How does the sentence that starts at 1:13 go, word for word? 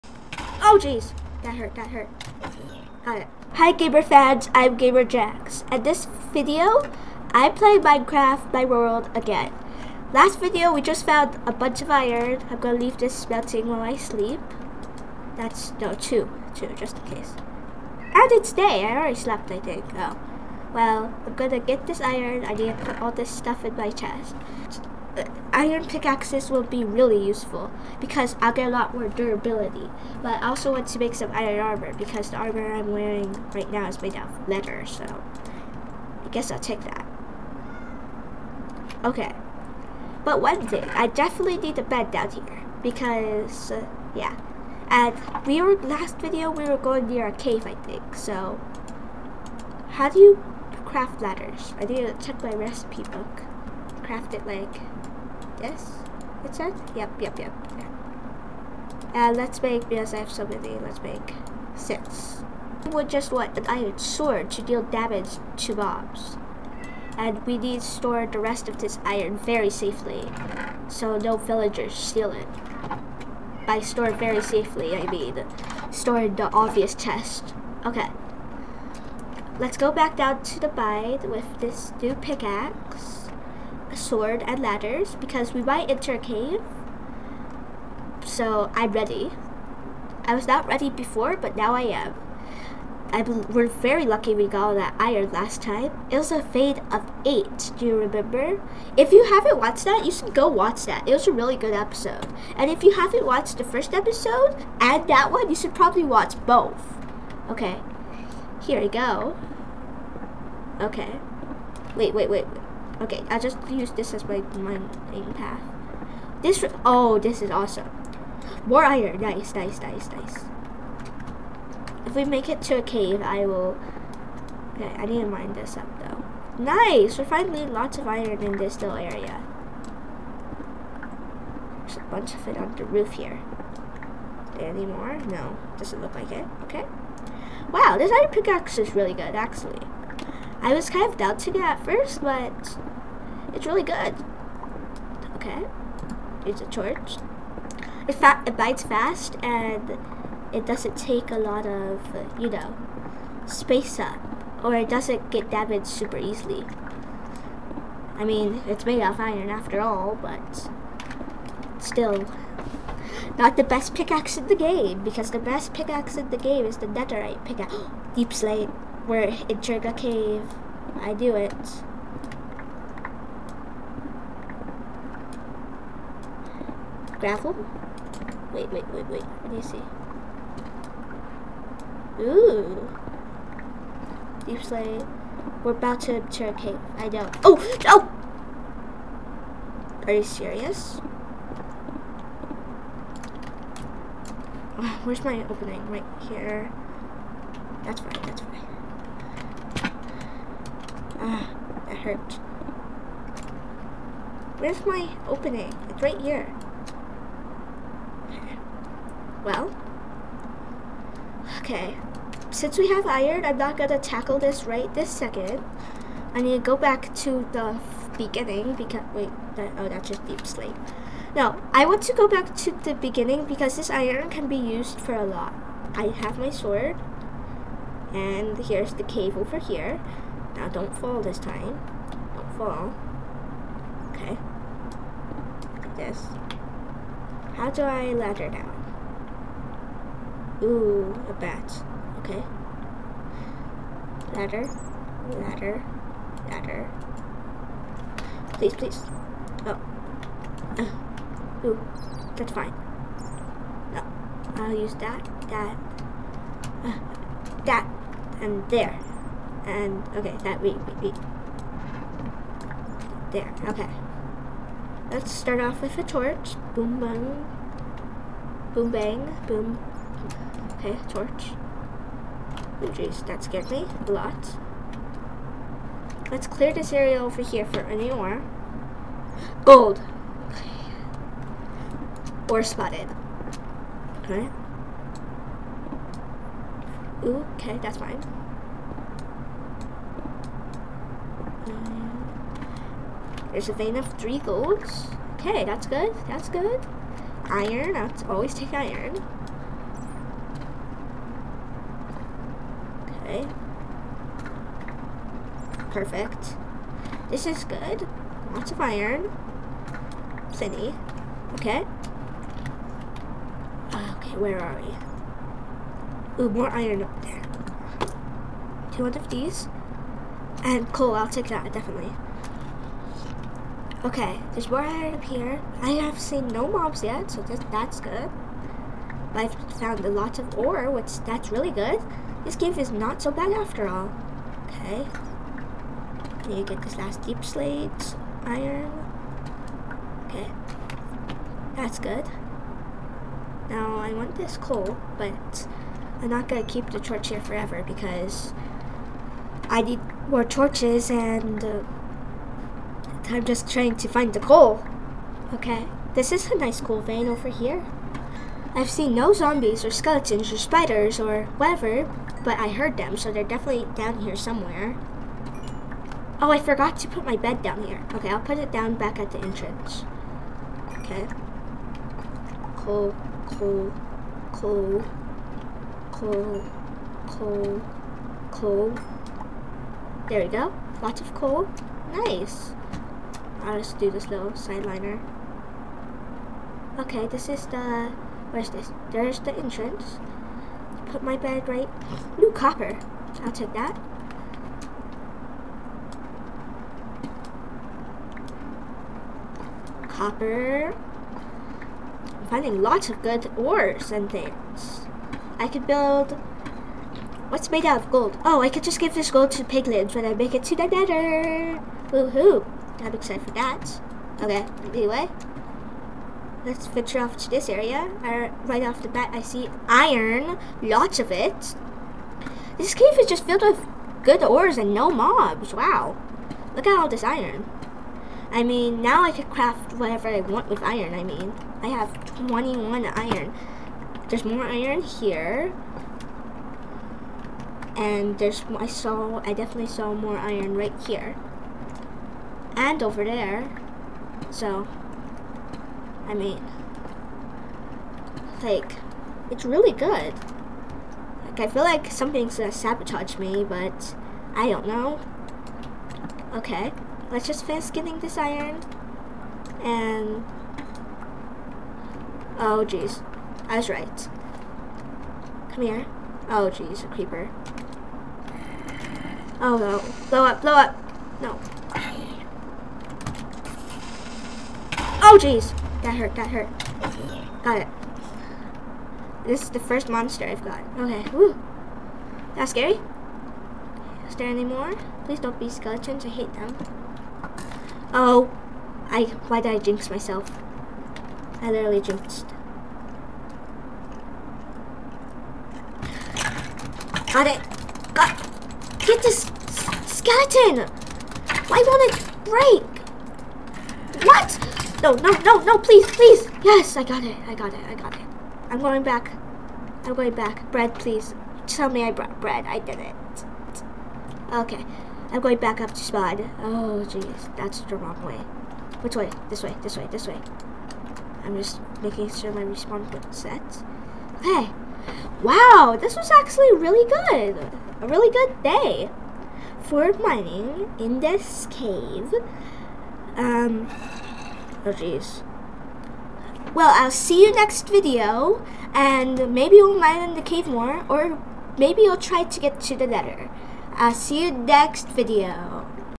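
By store very safely, I mean store in the obvious chest.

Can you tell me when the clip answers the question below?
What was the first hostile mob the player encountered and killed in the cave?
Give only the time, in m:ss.
7:47.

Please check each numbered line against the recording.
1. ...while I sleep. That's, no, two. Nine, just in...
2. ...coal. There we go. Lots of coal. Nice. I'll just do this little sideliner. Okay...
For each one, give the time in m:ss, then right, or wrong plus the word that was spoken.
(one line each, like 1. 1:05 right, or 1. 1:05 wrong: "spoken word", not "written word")
1. 0:13 wrong: "Two", not "Nine"
2. 6:18 right.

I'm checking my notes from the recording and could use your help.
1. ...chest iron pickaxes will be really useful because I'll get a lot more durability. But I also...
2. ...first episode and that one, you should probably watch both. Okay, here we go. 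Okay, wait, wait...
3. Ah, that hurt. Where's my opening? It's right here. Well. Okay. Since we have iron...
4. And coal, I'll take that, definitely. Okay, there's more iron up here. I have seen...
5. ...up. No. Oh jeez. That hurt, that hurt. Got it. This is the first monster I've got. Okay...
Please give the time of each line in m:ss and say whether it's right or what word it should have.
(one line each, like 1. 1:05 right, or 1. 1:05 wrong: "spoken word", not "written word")
1. 0:23 right
2. 1:43 right
3. 3:21 right
4. 5:20 right
5. 7:50 right.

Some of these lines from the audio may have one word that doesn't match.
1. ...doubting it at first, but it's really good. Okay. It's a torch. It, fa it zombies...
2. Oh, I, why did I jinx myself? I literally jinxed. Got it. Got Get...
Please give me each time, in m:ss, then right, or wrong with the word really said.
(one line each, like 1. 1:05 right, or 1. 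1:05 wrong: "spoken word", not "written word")
1. 2:21 wrong: "bites", not "zombies"
2. 8:08 right.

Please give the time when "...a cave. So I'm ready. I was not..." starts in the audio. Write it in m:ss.
1:26.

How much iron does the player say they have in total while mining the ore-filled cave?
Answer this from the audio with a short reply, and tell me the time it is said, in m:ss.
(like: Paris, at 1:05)
21, at 7:12.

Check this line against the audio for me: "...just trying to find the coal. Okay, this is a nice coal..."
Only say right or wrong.
right.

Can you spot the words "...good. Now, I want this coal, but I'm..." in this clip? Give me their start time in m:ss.
5:41.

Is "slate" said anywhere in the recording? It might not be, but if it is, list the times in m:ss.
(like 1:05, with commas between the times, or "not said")
2:48, 3:04, 5:37.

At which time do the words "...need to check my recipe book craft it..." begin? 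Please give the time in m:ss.
0:51.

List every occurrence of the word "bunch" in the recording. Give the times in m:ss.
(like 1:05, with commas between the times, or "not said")
0:11, 2:12.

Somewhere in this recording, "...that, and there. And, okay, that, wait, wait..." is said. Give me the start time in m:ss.
4:17.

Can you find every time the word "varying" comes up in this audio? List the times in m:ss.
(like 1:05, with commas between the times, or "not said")
not said.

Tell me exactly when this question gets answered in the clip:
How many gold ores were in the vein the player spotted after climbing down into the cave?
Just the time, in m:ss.
4:54.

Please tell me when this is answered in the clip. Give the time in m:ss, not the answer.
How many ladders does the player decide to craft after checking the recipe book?
1:01.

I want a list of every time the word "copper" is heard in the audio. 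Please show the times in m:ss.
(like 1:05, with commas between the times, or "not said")
6:32, 6:40.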